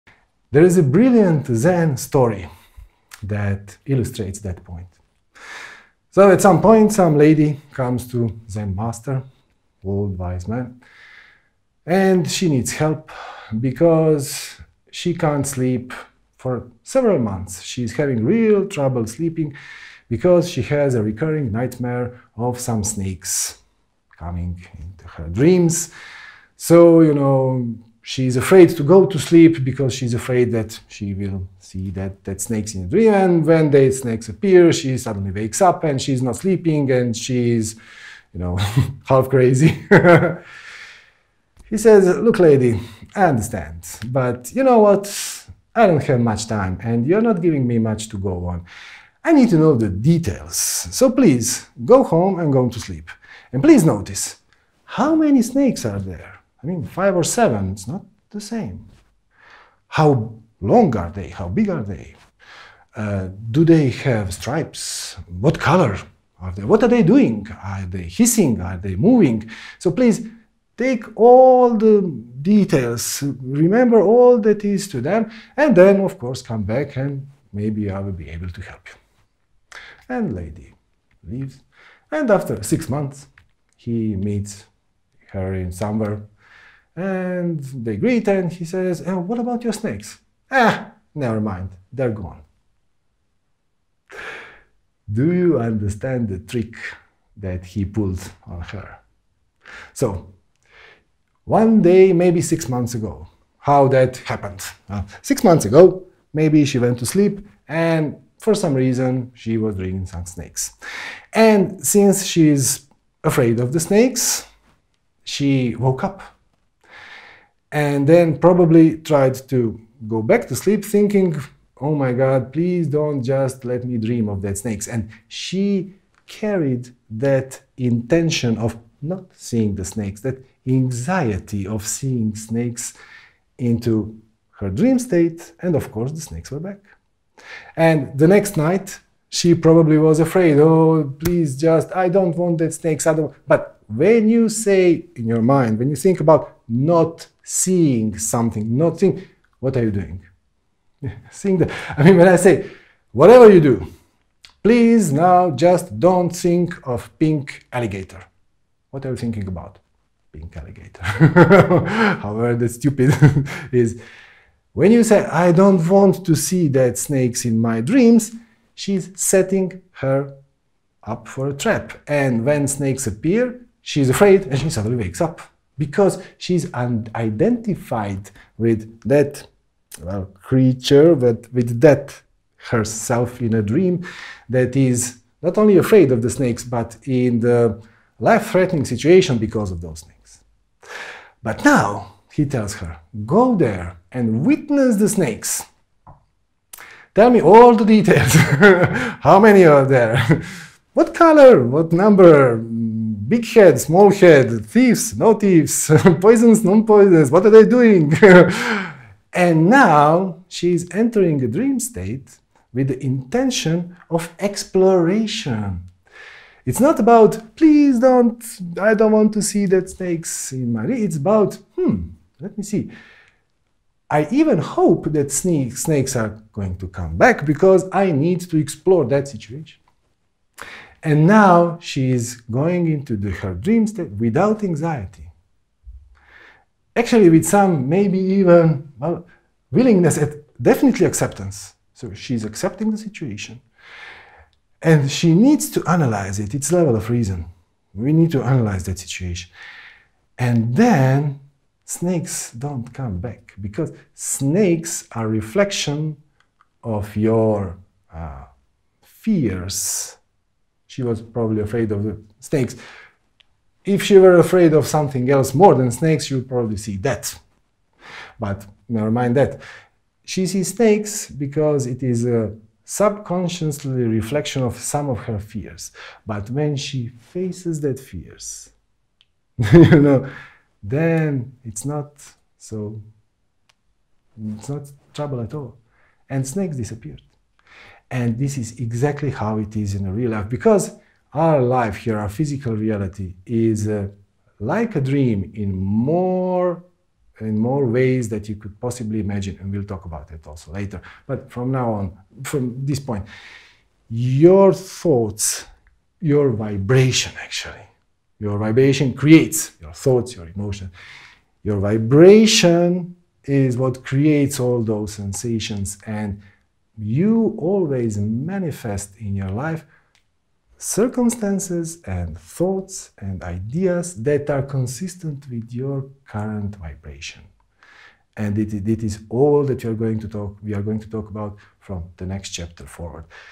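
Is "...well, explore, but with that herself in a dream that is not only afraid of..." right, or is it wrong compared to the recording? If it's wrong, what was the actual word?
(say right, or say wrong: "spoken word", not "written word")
wrong: "creature", not "explore".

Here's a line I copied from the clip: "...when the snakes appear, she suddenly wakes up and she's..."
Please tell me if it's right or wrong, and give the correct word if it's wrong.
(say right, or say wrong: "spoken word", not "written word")
right.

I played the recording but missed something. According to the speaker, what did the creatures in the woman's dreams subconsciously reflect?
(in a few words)
Her fears.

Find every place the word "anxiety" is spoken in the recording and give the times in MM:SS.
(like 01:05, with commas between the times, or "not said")
02:10, 03:54.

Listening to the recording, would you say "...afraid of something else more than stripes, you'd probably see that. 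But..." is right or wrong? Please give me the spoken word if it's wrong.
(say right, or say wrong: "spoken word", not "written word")
wrong: "snakes", not "stripes".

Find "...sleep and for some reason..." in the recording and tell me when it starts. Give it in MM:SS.
01:47.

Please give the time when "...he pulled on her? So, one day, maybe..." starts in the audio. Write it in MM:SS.
01:37.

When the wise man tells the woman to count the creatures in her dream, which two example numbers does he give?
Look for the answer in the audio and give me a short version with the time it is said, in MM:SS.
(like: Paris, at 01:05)
5 or 7, at 00:56.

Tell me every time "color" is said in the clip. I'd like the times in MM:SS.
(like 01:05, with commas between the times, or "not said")
01:05, 03:21.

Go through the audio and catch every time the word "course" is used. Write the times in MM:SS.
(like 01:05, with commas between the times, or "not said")
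01:16, 02:15.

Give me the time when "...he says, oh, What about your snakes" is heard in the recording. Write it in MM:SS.
01:28.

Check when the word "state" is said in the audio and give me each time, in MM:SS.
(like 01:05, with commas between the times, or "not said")
02:14, 03:31, 03:53.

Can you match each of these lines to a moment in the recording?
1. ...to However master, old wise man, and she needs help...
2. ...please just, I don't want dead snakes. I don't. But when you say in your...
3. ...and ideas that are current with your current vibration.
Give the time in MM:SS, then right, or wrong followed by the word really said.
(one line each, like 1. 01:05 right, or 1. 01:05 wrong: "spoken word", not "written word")
1. 00:08 wrong: "Zen", not "However"
2. 02:21 right
3. 05:23 wrong: "consistent", not "current".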